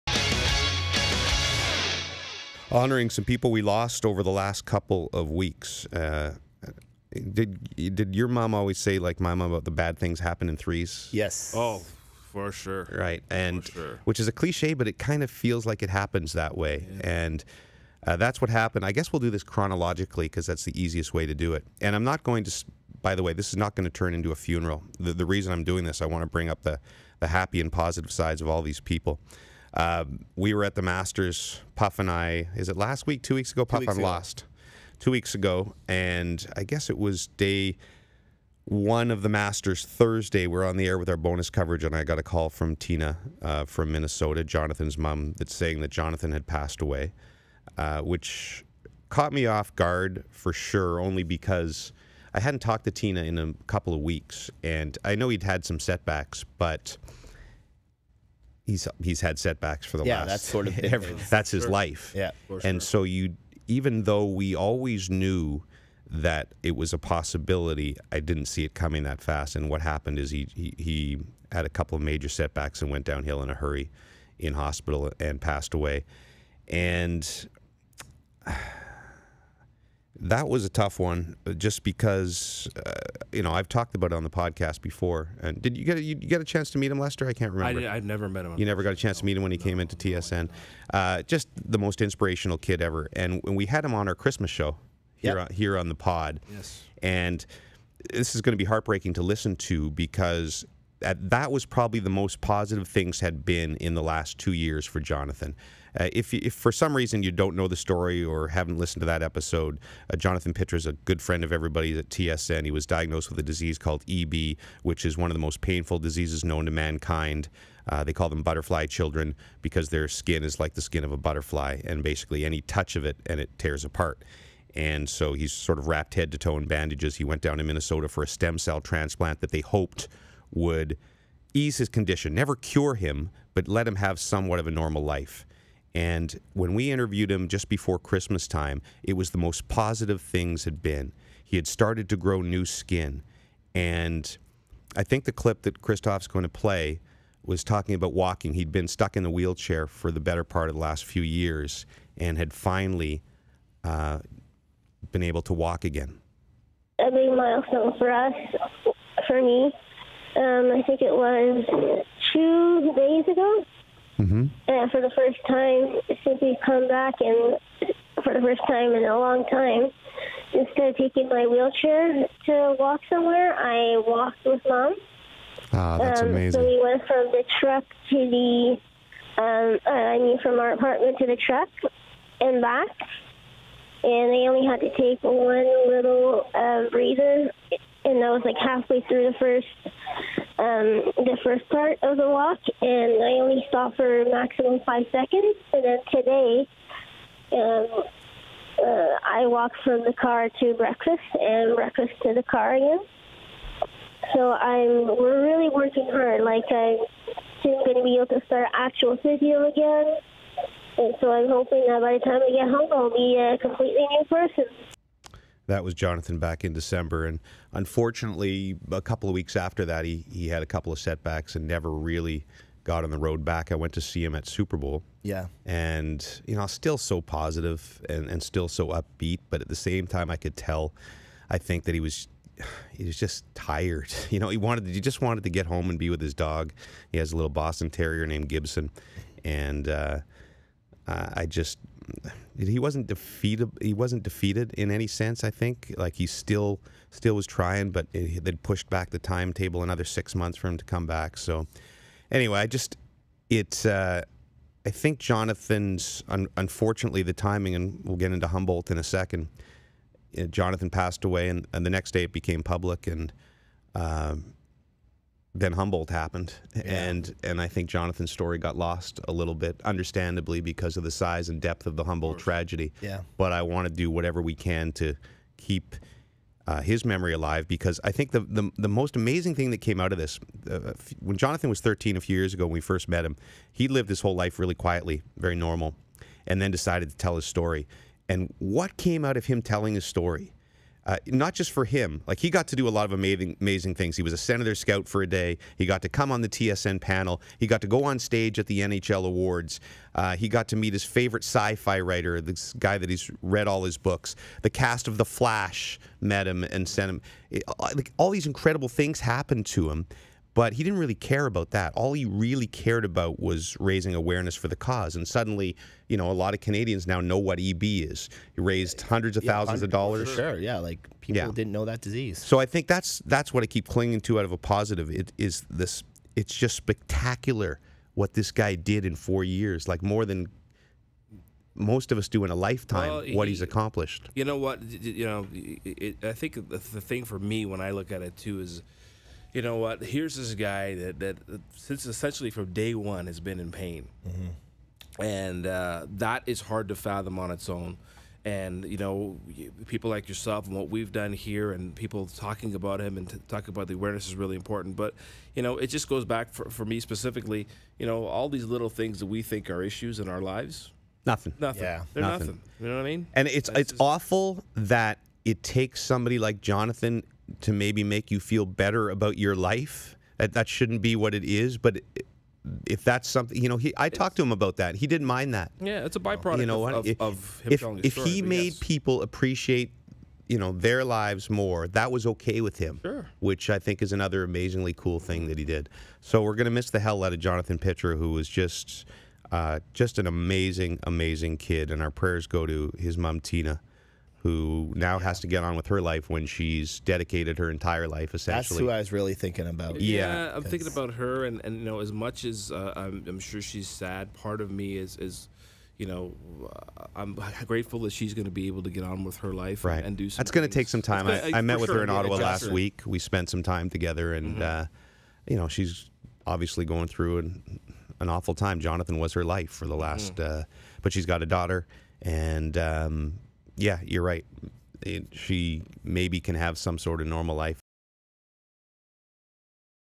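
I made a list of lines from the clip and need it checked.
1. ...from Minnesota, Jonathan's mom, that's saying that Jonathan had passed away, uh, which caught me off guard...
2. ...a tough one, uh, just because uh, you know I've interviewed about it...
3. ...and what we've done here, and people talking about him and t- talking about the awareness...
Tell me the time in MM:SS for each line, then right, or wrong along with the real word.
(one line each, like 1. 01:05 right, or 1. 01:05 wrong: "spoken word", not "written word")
1. 00:43 right
2. 01:20 wrong: "talked", not "interviewed"
3. 05:50 right.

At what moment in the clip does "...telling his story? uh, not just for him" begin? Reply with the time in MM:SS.
04:49.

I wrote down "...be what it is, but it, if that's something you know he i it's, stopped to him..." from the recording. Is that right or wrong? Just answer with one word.
wrong.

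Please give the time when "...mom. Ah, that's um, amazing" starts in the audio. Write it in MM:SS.
02:54.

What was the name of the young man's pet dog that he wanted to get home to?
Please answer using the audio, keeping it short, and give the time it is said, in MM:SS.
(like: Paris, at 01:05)
Gibson, at 03:58.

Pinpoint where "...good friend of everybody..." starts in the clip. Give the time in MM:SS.
01:50.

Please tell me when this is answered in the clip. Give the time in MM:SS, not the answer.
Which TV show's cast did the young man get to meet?
05:05.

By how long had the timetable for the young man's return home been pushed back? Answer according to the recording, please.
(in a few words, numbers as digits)
6 months.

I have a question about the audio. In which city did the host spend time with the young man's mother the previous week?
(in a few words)
Ottawa.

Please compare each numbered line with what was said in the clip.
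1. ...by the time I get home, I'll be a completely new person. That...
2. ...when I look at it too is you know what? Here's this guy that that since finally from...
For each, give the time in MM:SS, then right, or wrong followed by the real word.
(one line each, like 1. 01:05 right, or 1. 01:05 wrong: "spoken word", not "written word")
1. 03:32 right
2. 05:37 wrong: "essentially", not "finally".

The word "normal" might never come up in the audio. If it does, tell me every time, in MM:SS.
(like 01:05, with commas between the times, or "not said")
02:14, 04:45, 07:07.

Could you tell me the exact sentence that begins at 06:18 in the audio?
people appreciate you know their lives more that was okay with him sure.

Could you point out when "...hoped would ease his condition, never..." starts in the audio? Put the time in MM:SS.
02:09.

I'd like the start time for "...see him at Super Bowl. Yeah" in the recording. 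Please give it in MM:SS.
03:44.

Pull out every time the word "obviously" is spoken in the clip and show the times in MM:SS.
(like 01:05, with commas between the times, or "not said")
06:56.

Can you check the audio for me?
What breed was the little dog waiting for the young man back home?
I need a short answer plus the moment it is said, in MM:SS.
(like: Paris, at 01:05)
Boston Terrier, at 03:57.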